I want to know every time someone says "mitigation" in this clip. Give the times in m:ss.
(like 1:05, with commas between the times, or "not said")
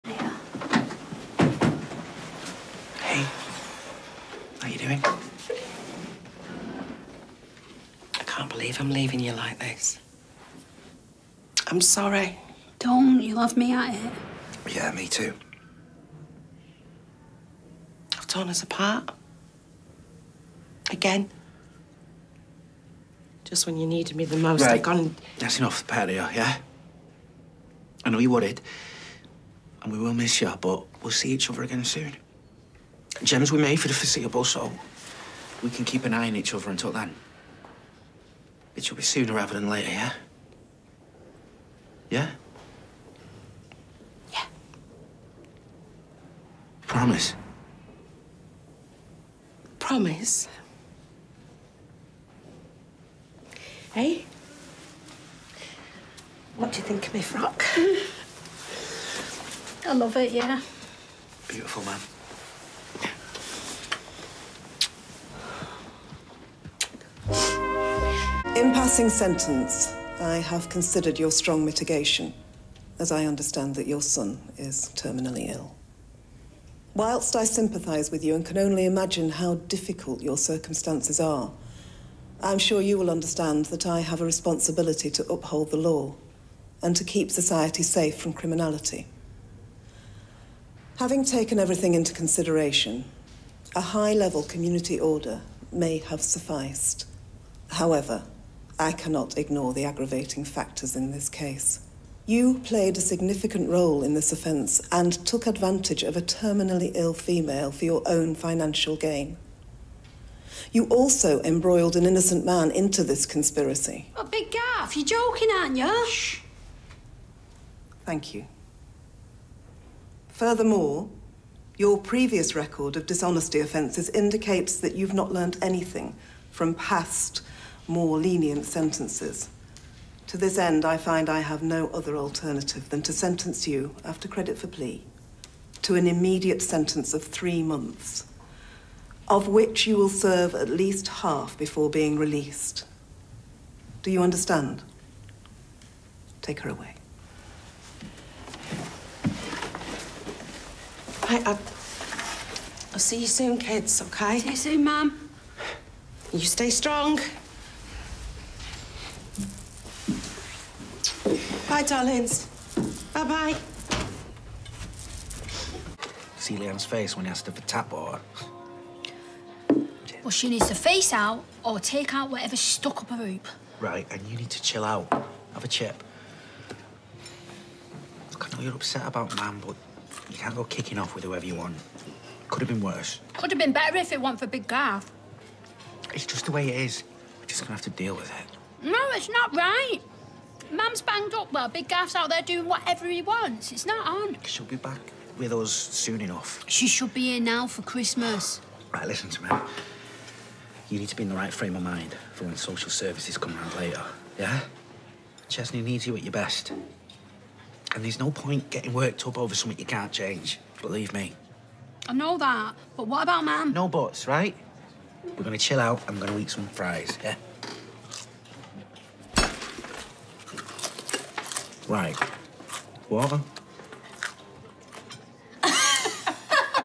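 1:11.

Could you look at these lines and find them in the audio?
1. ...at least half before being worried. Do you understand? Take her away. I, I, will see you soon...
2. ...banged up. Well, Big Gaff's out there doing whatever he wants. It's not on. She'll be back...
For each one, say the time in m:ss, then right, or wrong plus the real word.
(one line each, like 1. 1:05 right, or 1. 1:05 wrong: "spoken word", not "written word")
1. 2:20 wrong: "released", not "worried"
2. 3:11 right.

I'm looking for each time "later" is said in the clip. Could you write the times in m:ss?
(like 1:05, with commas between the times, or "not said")
0:39, 3:23.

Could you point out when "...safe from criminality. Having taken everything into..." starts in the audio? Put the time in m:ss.
1:27.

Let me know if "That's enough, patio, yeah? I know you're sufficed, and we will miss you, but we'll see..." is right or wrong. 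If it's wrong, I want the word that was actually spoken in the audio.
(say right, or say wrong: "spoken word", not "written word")
wrong: "worried", not "sufficed".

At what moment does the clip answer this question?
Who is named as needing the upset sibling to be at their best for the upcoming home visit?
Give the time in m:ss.
3:25.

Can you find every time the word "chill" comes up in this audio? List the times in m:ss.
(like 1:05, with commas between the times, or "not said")
2:54, 3:35.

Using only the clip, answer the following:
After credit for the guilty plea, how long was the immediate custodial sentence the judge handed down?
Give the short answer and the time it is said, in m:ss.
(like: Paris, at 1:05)
3 months, at 2:17.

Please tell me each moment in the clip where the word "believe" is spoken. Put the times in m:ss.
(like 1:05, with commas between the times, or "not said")
0:08, 3:30.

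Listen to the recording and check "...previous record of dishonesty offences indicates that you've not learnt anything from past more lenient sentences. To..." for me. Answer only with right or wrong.
right.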